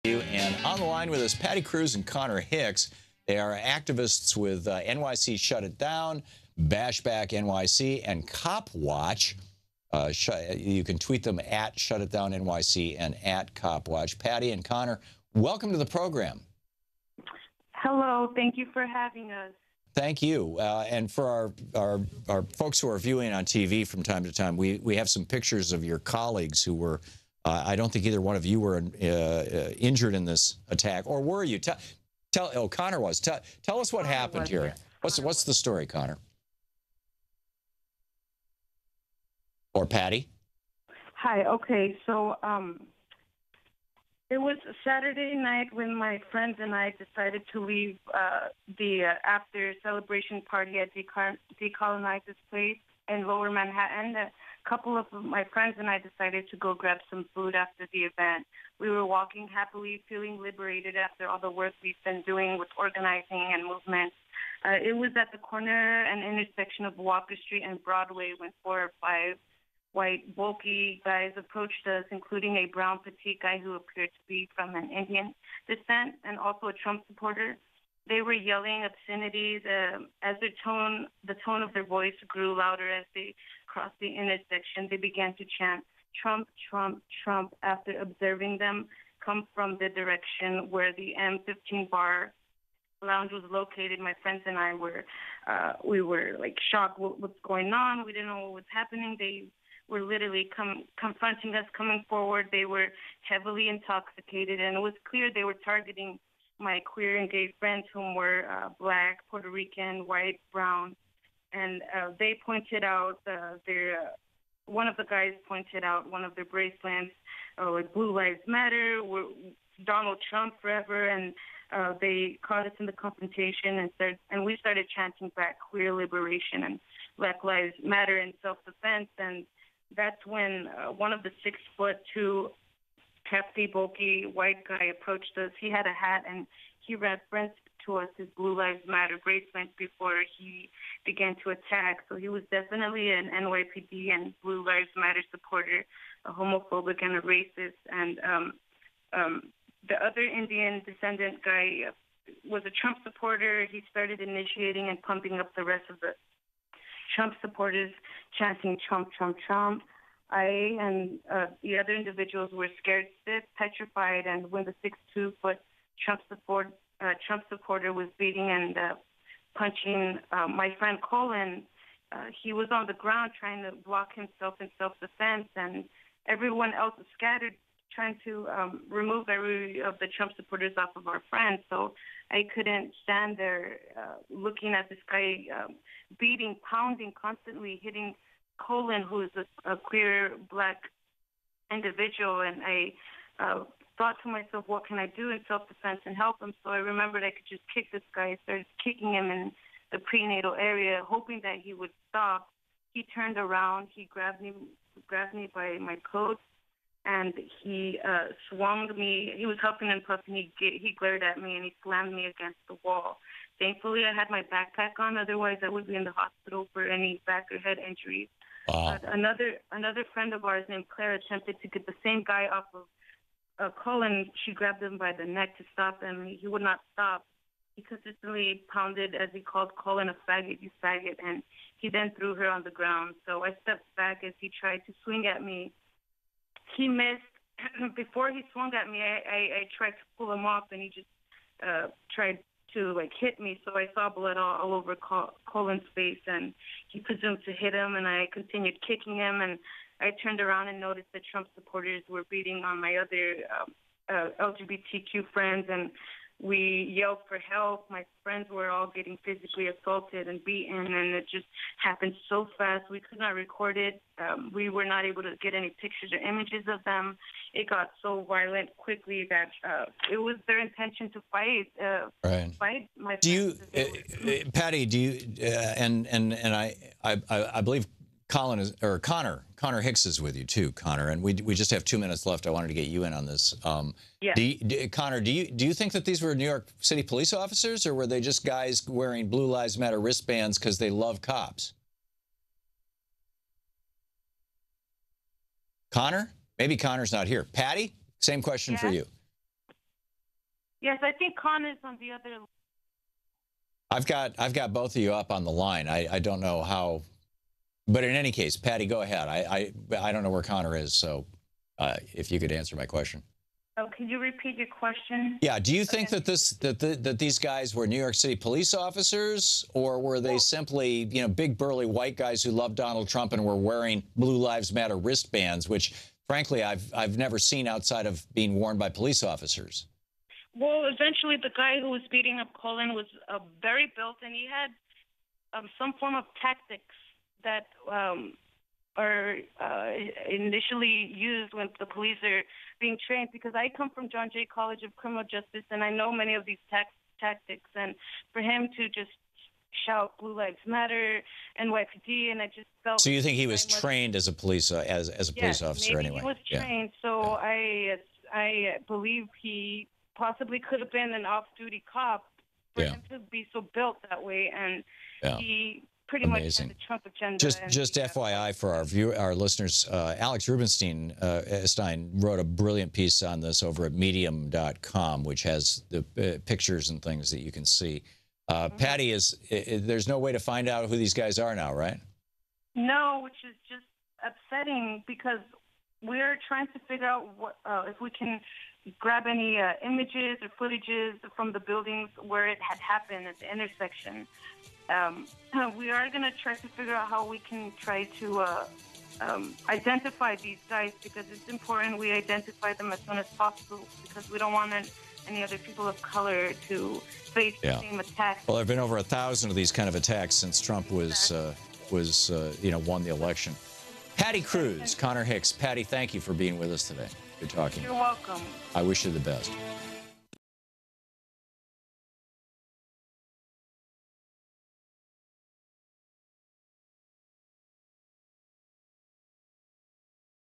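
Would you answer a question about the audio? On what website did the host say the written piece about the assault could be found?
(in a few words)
Medium.com.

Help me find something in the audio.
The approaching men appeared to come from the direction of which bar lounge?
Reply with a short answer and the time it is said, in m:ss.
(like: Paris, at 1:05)
M15, at 1:31.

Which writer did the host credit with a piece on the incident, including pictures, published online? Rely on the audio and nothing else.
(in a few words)
Alex Rubenstein.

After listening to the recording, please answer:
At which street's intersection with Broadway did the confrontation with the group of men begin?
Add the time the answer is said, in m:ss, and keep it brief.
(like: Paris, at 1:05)
Walker Street, at 1:06.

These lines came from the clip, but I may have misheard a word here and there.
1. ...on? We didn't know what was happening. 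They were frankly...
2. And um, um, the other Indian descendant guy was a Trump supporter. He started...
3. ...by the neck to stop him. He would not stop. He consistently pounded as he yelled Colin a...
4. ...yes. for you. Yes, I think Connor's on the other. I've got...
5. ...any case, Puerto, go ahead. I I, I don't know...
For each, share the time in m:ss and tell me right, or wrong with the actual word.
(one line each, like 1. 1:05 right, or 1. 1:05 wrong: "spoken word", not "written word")
1. 1:37 wrong: "literally", not "frankly"
2. 2:27 right
3. 3:44 wrong: "called", not "yelled"
4. 4:58 right
5. 5:08 wrong: "Patti", not "Puerto".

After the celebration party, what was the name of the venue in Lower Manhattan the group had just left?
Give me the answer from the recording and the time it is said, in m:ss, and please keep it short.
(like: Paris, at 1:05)
Decolonize This Place, at 0:50.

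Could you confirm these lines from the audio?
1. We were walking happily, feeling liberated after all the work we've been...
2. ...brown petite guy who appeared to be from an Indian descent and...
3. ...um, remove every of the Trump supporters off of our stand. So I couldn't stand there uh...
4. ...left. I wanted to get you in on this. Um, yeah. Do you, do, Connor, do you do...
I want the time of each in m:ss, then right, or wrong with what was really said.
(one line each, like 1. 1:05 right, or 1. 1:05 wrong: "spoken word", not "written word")
1. 0:58 right
2. 1:12 right
3. 2:58 wrong: "friend", not "stand"
4. 4:42 right.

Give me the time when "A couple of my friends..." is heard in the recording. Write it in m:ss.
0:54.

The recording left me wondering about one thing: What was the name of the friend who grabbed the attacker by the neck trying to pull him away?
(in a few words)
Claire.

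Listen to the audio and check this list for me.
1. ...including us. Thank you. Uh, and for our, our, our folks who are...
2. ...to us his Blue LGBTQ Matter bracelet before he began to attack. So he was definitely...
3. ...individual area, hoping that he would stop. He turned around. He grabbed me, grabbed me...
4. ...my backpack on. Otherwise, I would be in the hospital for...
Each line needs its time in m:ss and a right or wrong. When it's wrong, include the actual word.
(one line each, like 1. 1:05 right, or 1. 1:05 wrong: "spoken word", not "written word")
1. 0:18 wrong: "having", not "including"
2. 2:17 wrong: "Lives", not "LGBTQ"
3. 3:19 wrong: "prenatal", not "individual"
4. 3:34 right.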